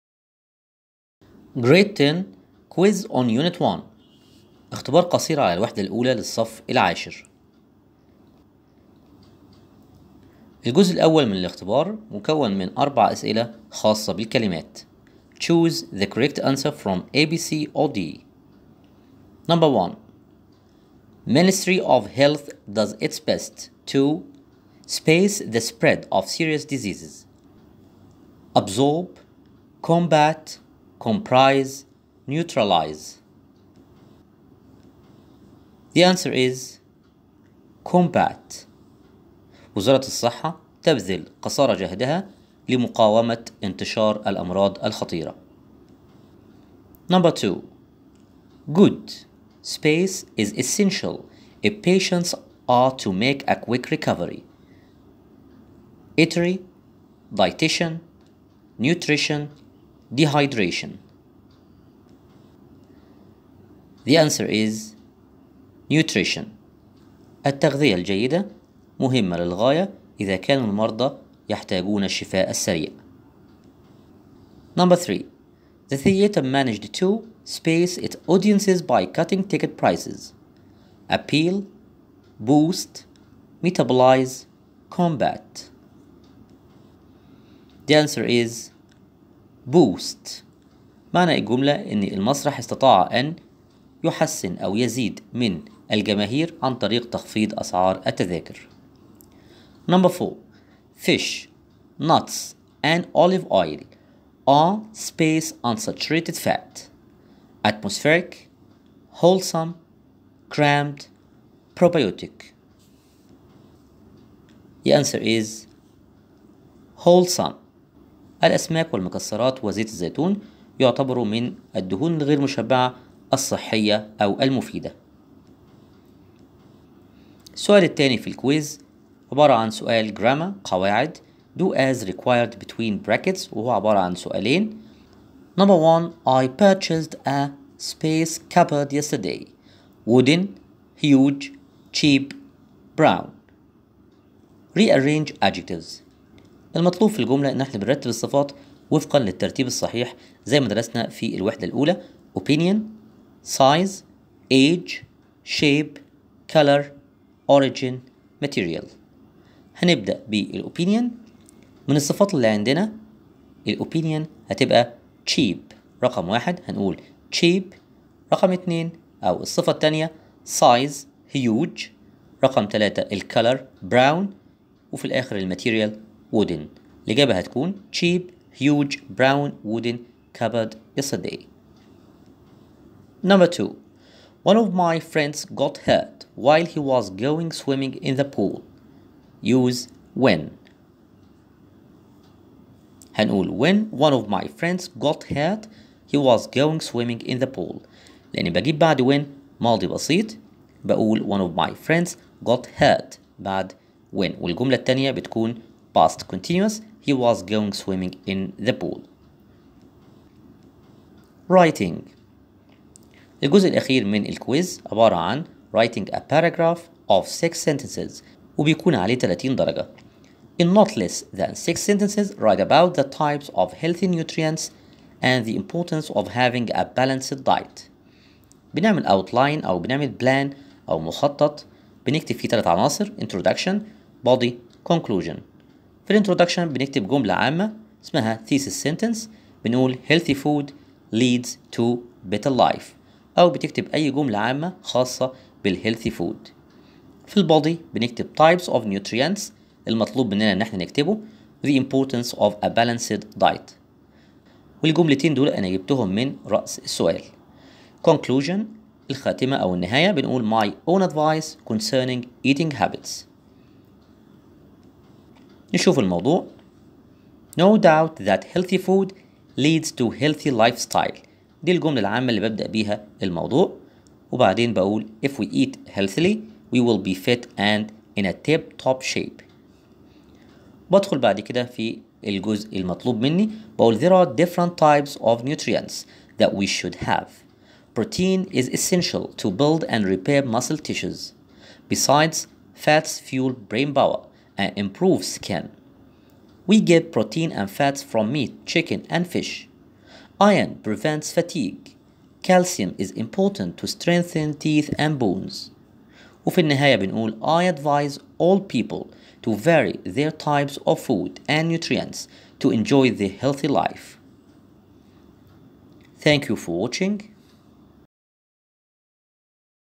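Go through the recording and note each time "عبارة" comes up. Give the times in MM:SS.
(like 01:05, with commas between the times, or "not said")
02:09, 02:13, 03:34.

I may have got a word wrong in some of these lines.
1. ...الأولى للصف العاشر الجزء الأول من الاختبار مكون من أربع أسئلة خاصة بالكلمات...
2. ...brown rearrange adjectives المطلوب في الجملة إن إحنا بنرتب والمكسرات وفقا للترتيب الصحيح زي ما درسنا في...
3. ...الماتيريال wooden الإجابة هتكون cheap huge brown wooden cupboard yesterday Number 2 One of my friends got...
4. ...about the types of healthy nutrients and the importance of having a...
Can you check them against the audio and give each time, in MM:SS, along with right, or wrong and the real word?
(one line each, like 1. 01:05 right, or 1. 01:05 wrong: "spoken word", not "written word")
1. 00:05 right
2. 02:22 wrong: "الصفات", not "والمكسرات"
3. 02:55 right
4. 03:42 right.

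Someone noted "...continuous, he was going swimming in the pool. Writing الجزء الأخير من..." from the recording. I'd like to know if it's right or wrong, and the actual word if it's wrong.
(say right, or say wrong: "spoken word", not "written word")
right.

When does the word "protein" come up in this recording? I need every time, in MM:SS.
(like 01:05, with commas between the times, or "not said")
04:47, 04:57.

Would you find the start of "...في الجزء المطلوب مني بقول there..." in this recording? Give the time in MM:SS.
04:41.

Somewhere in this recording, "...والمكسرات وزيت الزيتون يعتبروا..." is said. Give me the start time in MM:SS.
01:58.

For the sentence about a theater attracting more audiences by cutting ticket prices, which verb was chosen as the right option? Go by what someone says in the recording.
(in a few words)
boost.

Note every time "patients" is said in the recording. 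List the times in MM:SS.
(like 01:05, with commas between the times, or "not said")
00:51.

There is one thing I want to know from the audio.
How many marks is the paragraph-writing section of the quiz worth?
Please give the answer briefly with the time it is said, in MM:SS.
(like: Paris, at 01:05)
30, at 03:39.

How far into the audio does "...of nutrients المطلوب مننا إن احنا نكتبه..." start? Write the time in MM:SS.
04:08.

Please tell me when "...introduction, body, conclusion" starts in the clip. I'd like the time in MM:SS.
03:53.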